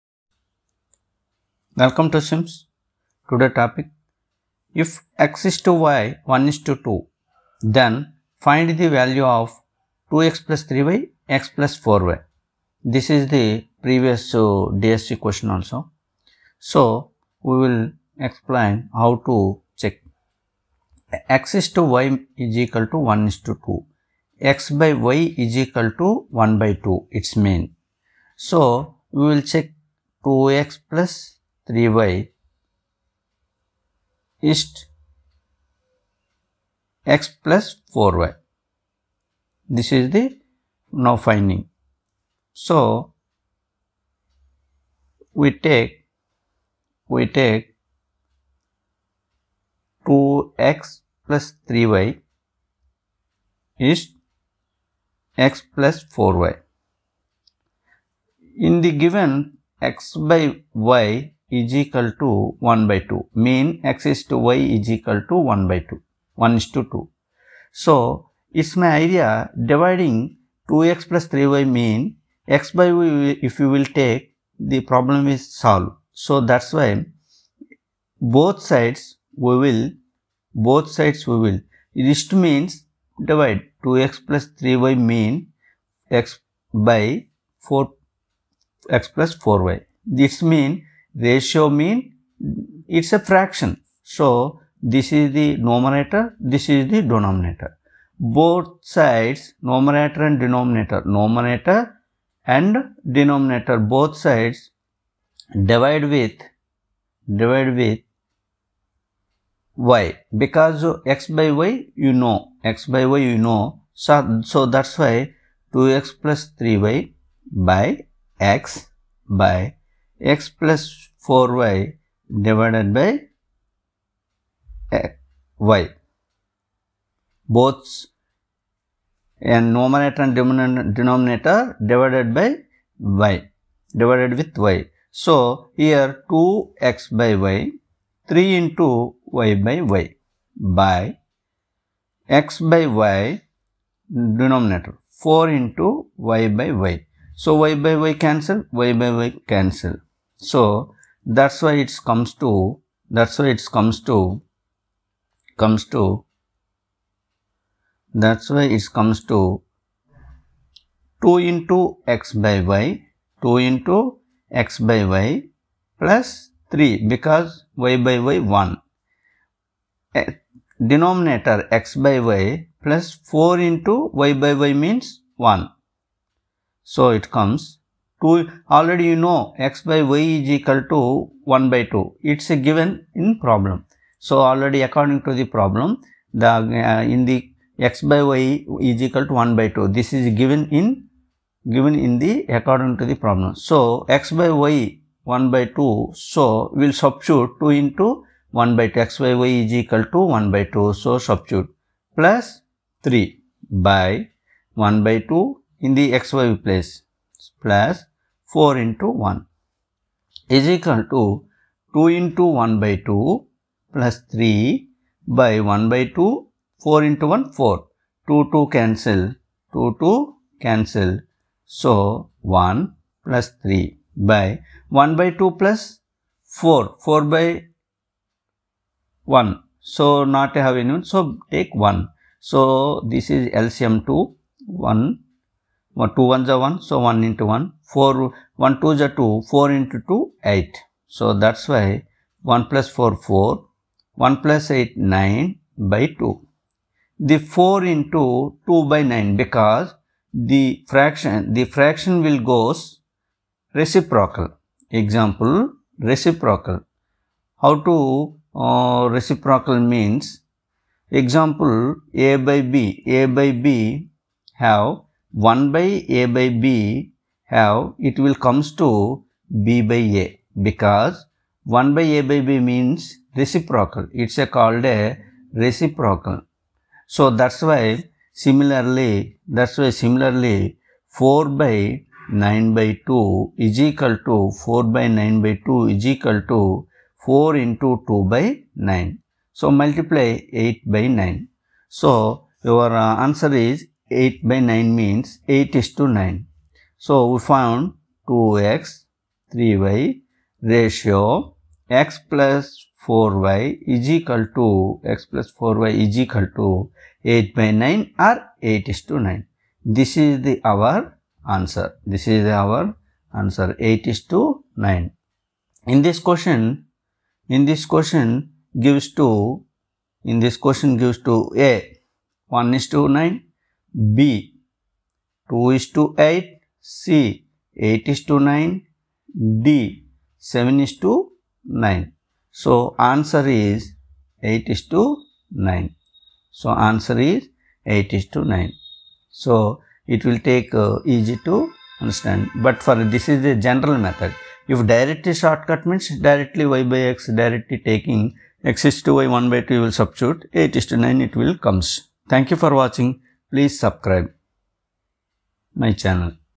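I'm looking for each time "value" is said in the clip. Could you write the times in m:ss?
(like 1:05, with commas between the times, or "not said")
0:08.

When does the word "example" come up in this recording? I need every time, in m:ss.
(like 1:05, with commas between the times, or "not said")
4:15, 4:21.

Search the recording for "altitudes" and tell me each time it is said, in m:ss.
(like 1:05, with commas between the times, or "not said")
not said.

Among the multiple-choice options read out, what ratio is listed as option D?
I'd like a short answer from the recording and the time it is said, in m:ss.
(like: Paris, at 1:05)
7:9, at 5:30.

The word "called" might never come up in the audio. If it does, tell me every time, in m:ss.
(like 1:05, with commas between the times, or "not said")
4:34.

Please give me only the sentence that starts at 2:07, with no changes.
Both and numerator and denominator divided by y divided with y.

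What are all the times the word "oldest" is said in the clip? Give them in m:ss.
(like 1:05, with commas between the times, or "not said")
not said.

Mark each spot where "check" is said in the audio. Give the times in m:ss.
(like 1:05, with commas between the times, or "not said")
0:19, 0:29.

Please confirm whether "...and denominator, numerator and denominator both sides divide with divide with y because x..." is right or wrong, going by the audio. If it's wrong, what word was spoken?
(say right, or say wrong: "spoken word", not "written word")
right.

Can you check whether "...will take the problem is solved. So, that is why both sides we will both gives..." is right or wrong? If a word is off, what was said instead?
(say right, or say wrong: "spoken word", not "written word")
wrong: "sides", not "gives".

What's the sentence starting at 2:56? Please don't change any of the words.
So, it comes 2 already you know x by y is equal to 1 by 2 it's a given in problem.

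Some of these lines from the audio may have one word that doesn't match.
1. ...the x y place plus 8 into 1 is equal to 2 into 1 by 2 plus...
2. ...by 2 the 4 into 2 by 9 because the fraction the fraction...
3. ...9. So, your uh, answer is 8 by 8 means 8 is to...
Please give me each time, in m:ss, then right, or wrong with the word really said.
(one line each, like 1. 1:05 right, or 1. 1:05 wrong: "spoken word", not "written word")
1. 3:25 wrong: "4", not "8"
2. 4:05 right
3. 4:51 wrong: "9", not "8".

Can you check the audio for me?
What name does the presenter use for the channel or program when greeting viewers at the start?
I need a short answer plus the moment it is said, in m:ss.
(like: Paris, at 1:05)
Sims, at 0:02.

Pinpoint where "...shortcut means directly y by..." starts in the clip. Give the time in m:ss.
5:45.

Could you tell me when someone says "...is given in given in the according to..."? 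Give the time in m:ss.
3:10.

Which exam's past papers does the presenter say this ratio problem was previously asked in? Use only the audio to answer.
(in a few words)
DSC.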